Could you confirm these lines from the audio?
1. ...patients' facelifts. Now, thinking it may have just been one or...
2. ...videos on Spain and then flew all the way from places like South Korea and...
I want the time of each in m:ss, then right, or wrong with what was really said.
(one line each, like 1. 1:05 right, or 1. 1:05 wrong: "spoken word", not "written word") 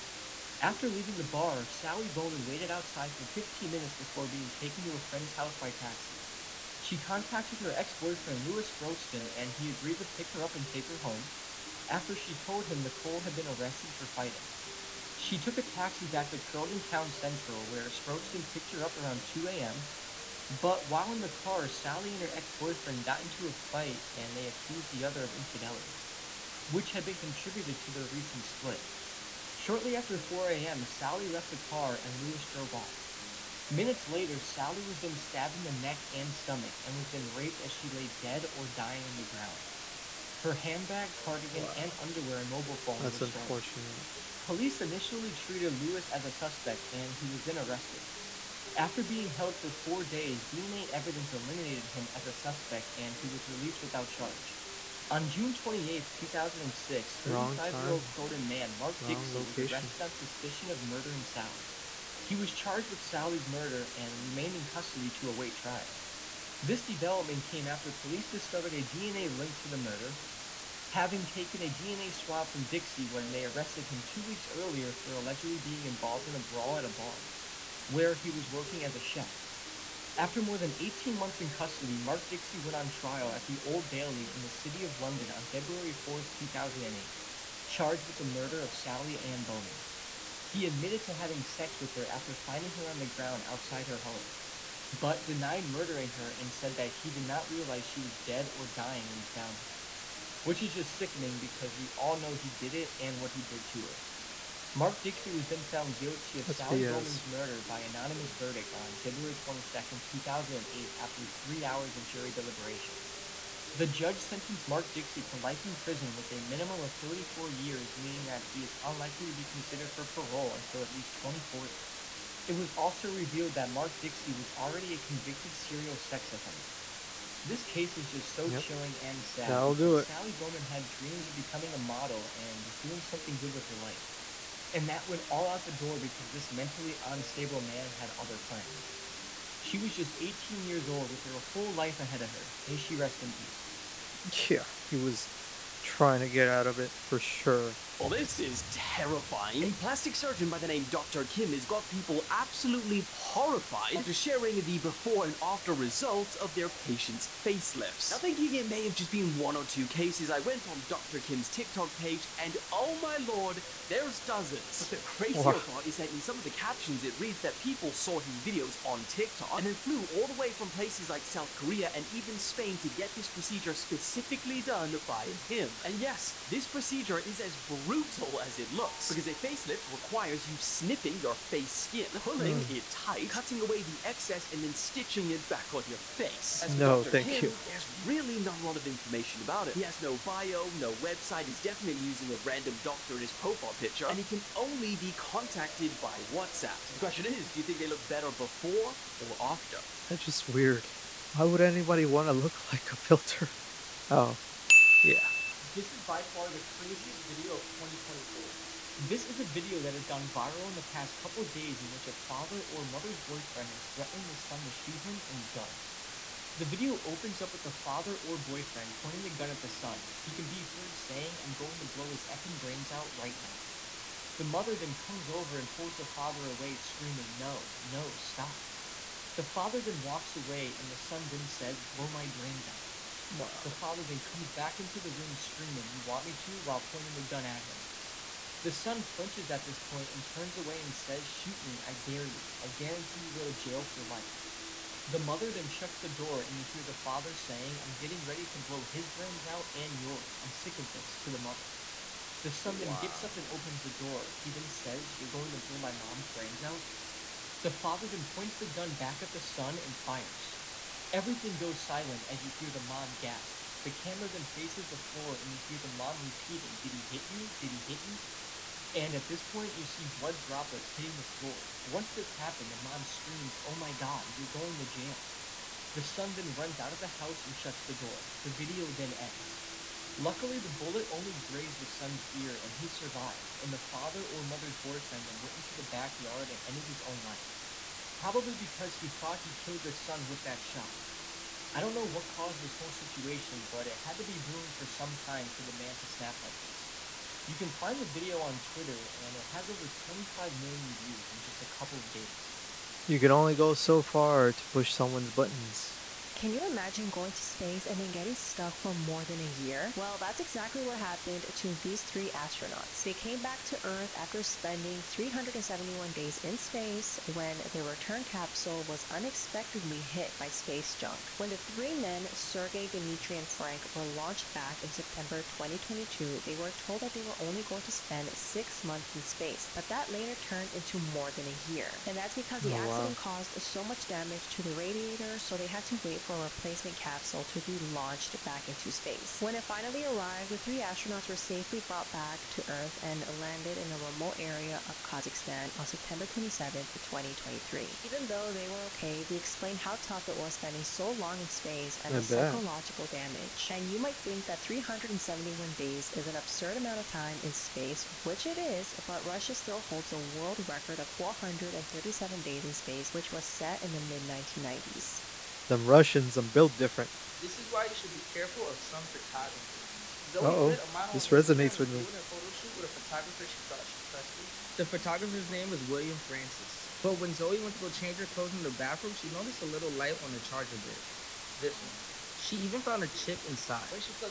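1. 2:36 right
2. 2:48 wrong: "TikTok", not "Spain".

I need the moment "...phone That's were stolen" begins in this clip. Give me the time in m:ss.
0:42.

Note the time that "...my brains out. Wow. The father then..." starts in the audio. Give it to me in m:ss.
3:52.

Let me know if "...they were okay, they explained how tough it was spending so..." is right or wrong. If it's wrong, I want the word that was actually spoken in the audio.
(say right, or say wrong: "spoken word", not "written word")
right.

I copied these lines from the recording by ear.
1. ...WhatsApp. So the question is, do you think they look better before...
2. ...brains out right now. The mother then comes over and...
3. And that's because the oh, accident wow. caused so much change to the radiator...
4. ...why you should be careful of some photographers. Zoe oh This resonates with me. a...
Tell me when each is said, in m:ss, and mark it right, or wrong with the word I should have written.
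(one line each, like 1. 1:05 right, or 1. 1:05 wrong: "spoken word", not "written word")
1. 3:16 right
2. 3:42 right
3. 5:32 wrong: "damage", not "change"
4. 6:07 right.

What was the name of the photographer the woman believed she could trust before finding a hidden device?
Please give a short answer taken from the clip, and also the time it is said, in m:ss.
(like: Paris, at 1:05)
William Francis, at 6:15.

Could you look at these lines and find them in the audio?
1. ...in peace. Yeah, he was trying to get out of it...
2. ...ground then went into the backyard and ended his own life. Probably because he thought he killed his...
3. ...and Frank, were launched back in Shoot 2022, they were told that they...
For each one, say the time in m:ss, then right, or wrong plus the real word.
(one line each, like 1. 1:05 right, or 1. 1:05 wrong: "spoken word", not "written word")
1. 2:23 right
2. 4:44 wrong: "boyfriend", not "ground"
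3. 5:23 wrong: "September", not "Shoot".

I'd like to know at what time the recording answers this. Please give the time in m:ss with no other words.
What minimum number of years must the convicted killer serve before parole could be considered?
1:57.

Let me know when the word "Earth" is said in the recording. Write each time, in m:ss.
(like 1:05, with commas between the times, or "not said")
5:13, 5:42.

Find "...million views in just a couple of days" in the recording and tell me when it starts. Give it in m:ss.
5:00.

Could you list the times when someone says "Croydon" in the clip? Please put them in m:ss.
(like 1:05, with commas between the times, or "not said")
0:16, 0:58.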